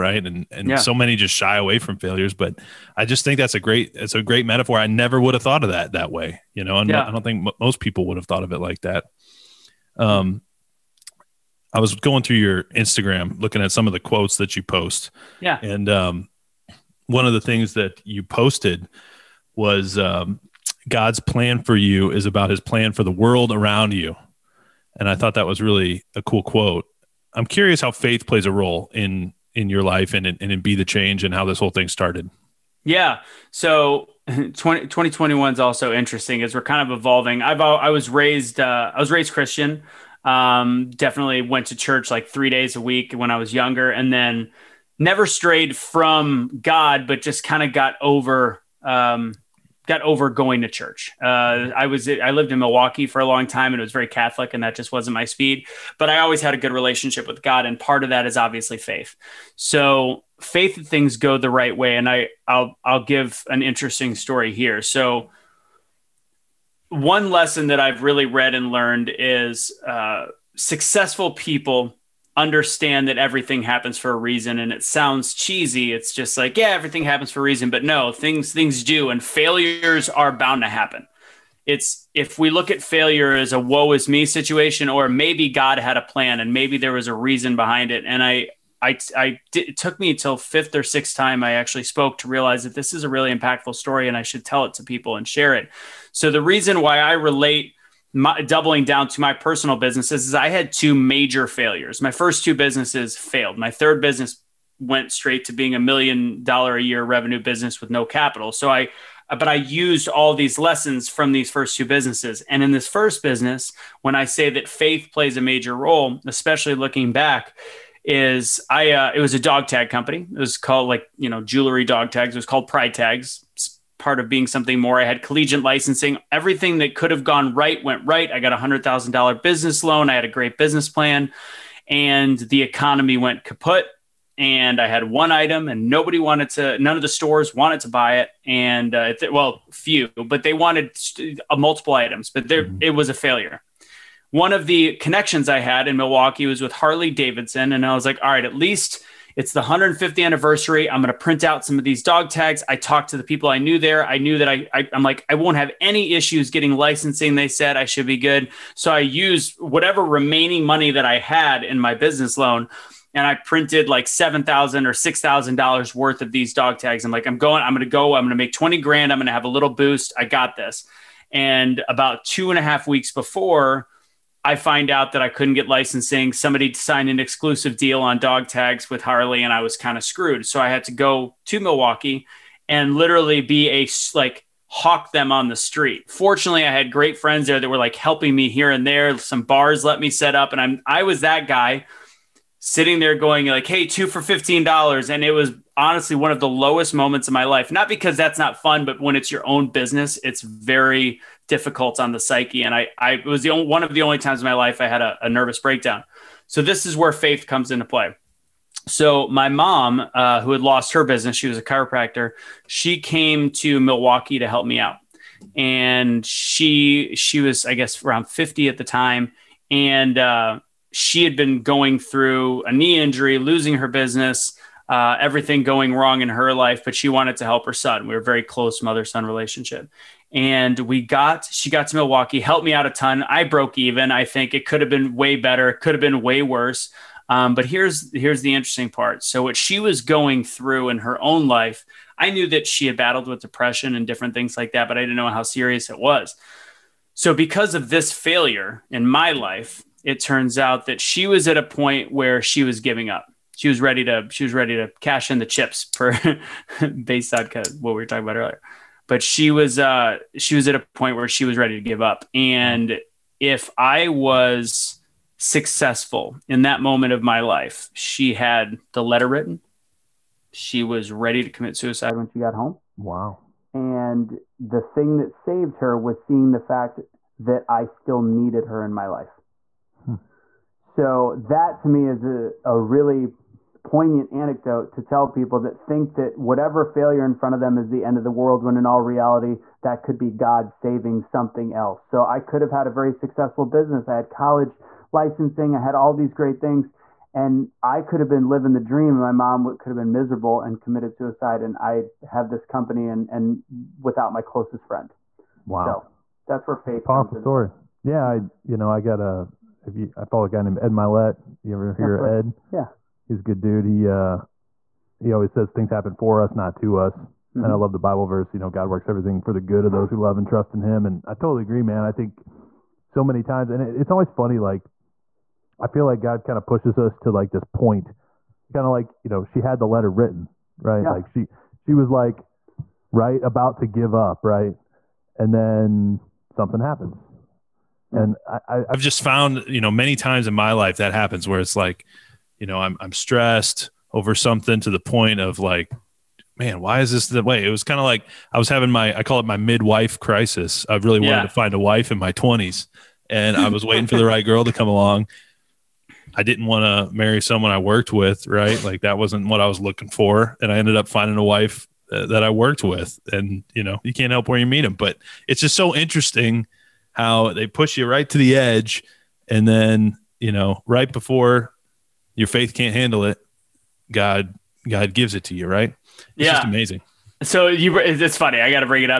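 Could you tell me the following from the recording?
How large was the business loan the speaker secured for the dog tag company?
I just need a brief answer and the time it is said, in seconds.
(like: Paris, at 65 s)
$100,000, at 128 s.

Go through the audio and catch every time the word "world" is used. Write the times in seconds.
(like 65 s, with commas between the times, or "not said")
23 s, 288 s.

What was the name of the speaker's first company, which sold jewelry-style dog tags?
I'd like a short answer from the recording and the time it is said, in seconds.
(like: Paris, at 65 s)
Pride Tags, at 122 s.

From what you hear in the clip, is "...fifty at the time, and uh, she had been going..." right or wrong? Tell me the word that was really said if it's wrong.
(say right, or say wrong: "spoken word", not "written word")
right.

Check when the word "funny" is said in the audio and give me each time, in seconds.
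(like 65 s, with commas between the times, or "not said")
324 s, 378 s.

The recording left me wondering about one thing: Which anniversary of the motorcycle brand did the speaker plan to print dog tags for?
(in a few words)
150th.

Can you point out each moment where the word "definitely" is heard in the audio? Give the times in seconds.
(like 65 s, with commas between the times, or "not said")
40 s.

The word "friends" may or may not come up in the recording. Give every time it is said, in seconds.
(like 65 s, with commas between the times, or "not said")
187 s, 304 s.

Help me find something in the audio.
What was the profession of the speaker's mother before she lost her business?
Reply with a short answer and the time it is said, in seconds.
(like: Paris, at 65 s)
Chiropractor, at 211 s.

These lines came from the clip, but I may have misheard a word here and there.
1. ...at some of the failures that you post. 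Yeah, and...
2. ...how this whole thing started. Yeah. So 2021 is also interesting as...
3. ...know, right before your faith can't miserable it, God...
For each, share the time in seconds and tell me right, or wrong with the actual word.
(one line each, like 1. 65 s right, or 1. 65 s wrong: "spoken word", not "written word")
1. 13 s wrong: "quotes", not "failures"
2. 31 s right
3. 370 s wrong: "handle", not "miserable".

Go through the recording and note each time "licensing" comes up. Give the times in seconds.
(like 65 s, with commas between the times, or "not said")
125 s, 156 s, 175 s, 295 s.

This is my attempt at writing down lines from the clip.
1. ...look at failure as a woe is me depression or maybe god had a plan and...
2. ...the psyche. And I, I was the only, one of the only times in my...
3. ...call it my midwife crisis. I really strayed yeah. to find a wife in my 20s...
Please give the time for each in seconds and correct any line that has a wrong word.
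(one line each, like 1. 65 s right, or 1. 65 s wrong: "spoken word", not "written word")
1. 82 s wrong: "situation", not "depression"
2. 202 s right
3. 349 s wrong: "wanted", not "strayed".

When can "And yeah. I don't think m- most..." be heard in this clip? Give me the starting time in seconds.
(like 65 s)
6 s.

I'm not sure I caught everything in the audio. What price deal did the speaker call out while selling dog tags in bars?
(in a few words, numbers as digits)
2 for $15.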